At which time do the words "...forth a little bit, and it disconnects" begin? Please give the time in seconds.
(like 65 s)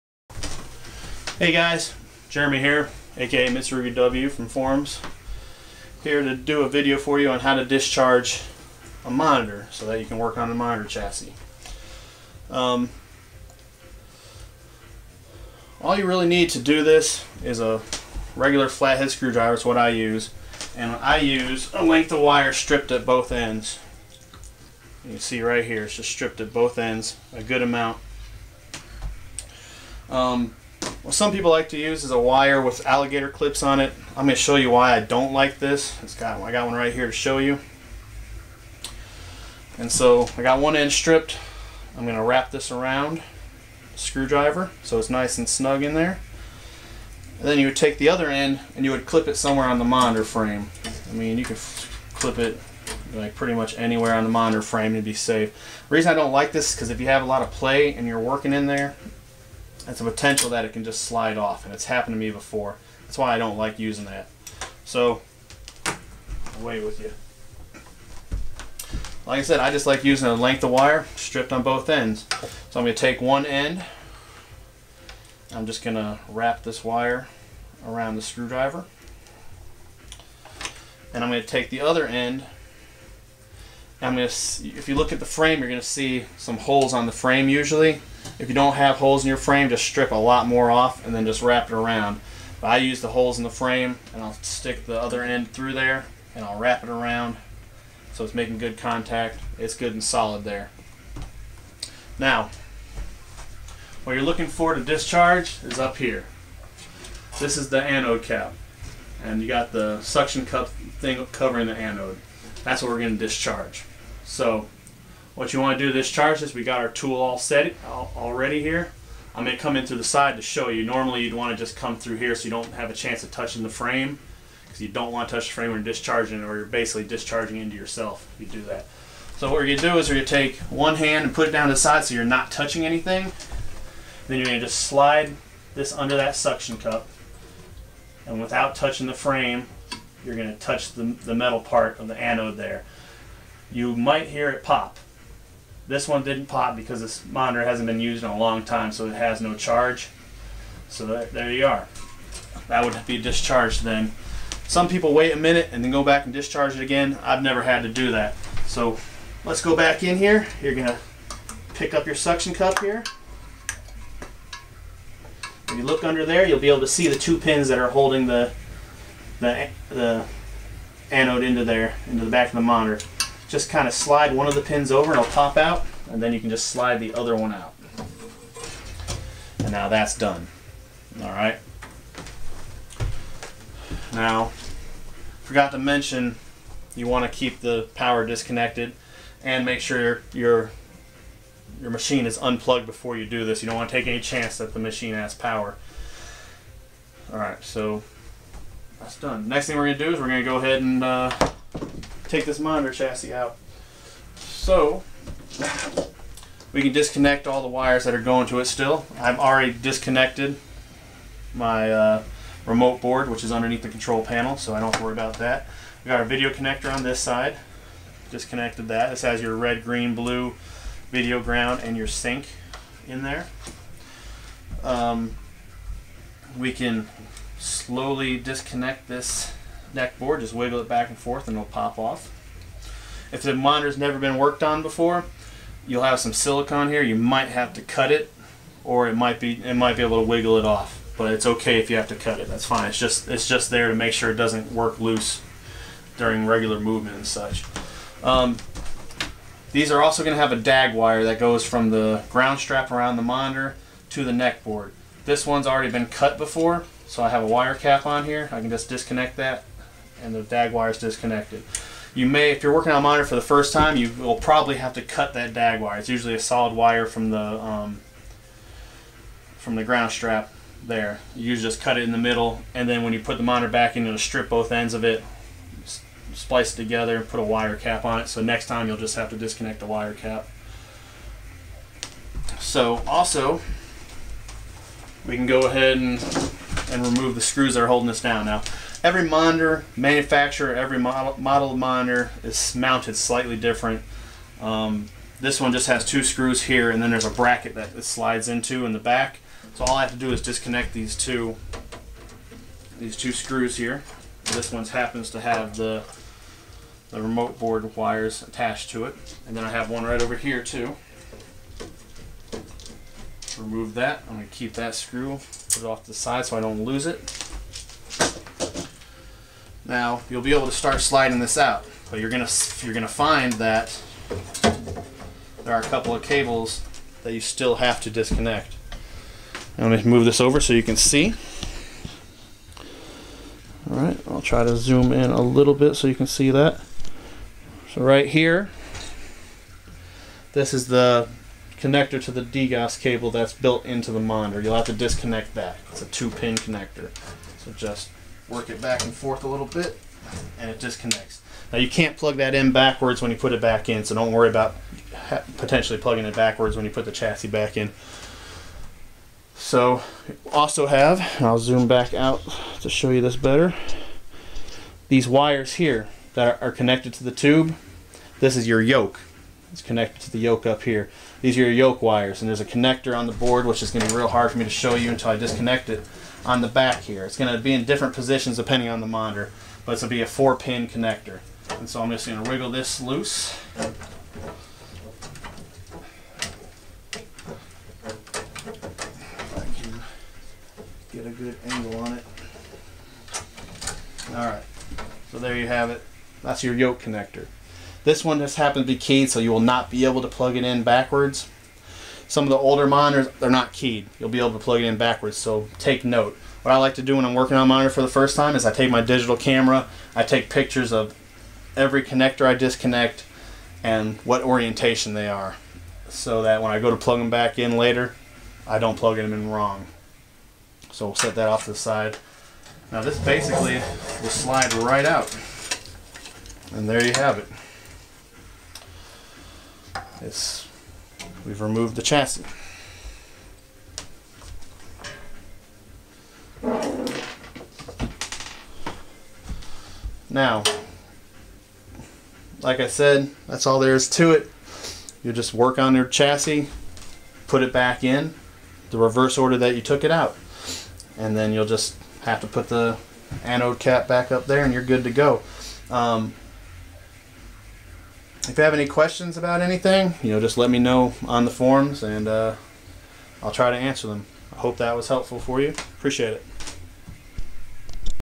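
349 s.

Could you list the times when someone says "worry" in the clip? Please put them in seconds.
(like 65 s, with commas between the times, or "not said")
215 s, 354 s.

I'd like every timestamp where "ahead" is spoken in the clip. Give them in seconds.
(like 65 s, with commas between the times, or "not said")
200 s, 285 s.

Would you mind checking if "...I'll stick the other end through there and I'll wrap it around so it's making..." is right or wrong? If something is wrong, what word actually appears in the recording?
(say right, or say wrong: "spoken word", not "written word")
right.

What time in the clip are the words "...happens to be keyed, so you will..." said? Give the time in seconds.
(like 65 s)
398 s.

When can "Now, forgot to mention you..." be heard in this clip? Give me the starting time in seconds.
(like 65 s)
184 s.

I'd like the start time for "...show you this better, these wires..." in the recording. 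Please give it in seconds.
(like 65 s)
362 s.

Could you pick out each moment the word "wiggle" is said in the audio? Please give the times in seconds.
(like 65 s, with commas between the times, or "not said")
230 s, 240 s, 382 s.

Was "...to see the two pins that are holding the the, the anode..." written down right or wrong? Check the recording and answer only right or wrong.
right.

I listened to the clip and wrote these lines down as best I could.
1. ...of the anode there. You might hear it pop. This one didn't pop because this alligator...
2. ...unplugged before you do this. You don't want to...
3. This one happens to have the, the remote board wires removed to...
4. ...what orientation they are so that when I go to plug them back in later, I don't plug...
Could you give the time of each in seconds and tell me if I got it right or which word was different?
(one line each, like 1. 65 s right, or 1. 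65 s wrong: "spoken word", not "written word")
1. 141 s wrong: "monitor", not "alligator"
2. 192 s right
3. 304 s wrong: "attached", not "removed"
4. 414 s right.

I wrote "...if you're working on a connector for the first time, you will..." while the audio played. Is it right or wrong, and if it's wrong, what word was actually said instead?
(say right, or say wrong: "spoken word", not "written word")
wrong: "monitor", not "connector".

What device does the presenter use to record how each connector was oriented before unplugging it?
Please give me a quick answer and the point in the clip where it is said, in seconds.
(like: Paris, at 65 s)
digital camera, at 409 s.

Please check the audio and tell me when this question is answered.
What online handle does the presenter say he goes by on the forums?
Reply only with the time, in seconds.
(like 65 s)
3 s.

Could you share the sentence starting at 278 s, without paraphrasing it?
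So next time you'll just have to disconnect the wire cap.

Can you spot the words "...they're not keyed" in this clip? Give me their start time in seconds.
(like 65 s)
403 s.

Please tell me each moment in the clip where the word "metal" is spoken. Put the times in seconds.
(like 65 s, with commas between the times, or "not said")
141 s.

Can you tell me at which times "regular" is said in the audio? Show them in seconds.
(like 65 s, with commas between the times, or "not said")
18 s, 246 s.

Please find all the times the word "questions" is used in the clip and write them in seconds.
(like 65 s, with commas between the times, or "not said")
458 s.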